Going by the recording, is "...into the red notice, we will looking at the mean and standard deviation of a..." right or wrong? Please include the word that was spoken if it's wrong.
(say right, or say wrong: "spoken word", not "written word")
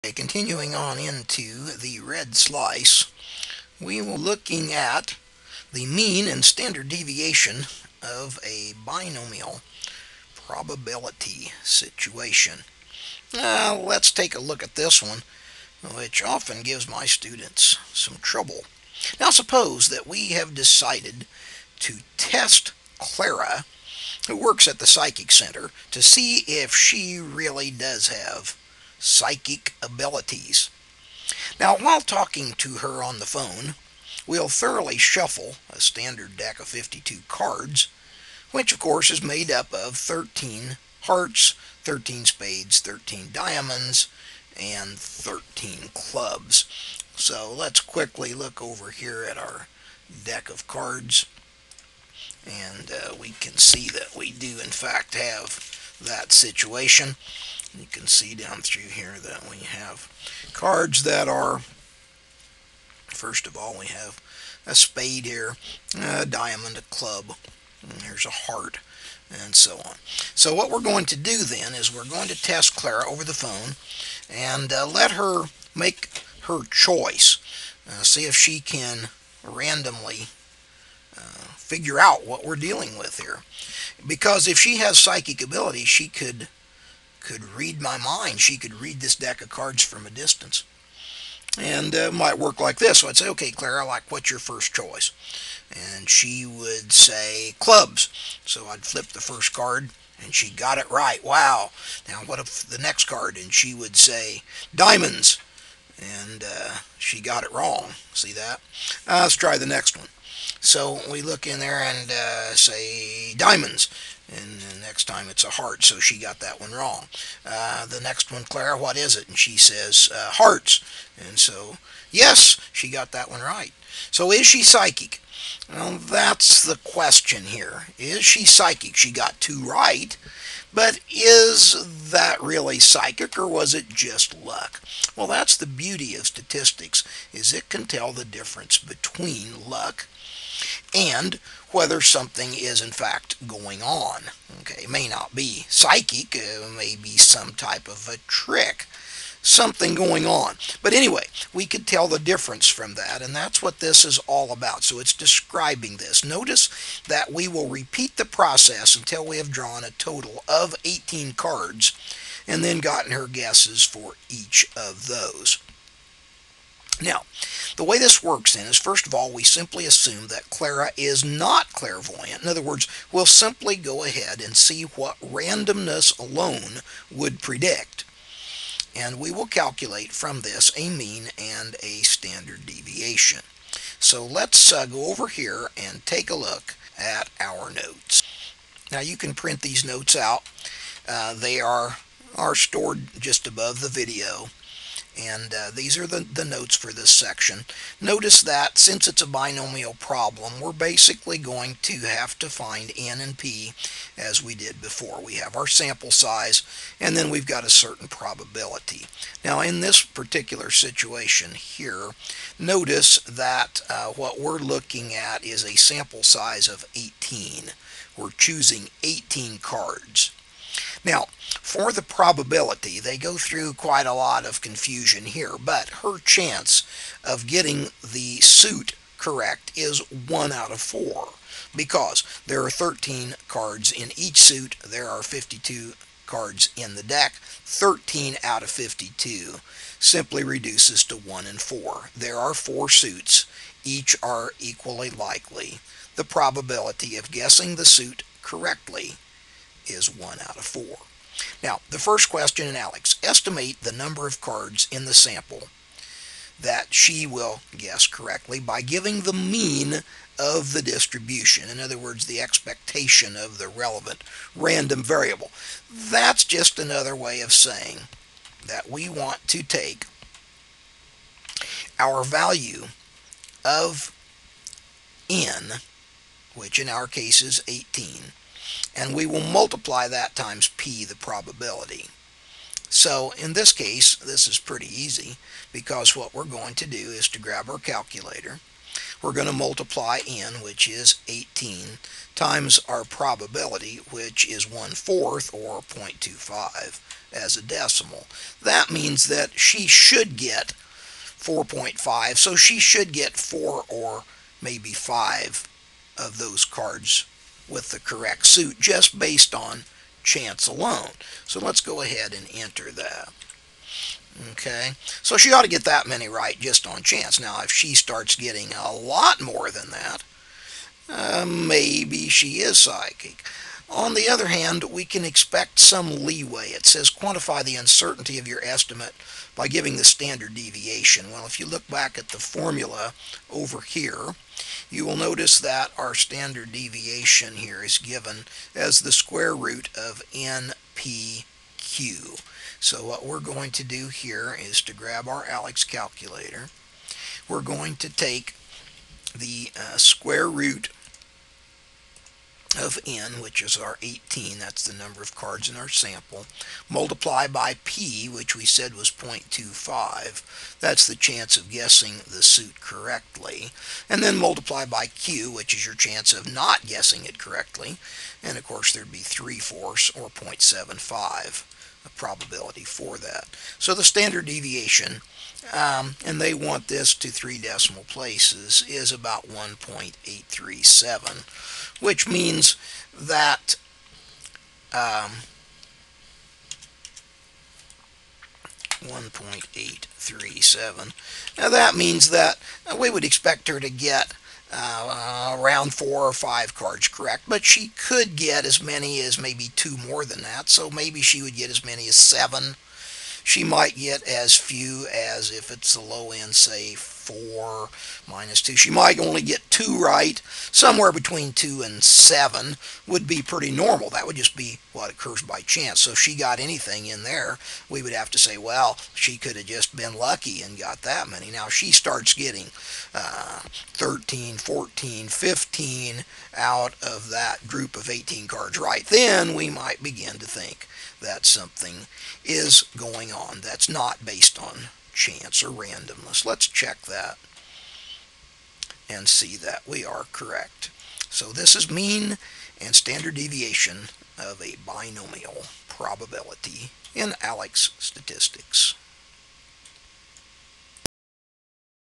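wrong: "slice", not "notice".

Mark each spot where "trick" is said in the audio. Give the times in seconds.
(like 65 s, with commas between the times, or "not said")
148 s.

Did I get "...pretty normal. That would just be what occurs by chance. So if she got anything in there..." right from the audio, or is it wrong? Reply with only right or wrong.
right.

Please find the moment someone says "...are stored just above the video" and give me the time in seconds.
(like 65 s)
192 s.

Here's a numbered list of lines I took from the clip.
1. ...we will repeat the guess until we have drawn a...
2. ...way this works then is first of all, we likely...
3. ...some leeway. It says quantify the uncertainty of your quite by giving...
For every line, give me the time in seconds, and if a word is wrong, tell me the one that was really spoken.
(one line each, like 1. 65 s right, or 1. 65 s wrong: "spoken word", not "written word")
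1. 157 s wrong: "process", not "guess"
2. 167 s wrong: "simply", not "likely"
3. 325 s wrong: "estimate", not "quite".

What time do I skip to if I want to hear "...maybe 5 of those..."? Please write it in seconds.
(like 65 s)
304 s.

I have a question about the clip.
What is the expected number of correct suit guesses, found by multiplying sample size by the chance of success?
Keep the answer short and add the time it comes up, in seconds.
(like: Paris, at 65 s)
4.5, at 301 s.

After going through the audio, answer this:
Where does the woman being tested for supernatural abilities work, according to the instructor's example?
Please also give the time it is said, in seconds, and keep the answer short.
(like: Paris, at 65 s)
Psychic Center, at 24 s.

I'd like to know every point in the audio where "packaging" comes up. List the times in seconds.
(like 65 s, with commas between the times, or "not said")
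not said.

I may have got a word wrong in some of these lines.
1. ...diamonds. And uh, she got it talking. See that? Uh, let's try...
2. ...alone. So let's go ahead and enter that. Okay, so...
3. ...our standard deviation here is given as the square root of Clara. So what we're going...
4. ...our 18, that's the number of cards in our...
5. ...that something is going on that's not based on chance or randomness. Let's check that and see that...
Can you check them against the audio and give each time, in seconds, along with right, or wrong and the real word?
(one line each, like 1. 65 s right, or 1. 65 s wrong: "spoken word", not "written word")
1. 104 s wrong: "wrong", not "talking"
2. 310 s right
3. 335 s wrong: "NPQ", not "Clara"
4. 353 s right
5. 431 s right.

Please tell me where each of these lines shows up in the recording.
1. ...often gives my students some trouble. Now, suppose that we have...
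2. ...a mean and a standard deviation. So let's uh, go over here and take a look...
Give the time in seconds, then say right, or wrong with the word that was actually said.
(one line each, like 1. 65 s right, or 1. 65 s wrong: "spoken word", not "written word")
1. 16 s right
2. 180 s right.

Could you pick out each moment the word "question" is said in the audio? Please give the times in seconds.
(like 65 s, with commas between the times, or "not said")
126 s, 252 s.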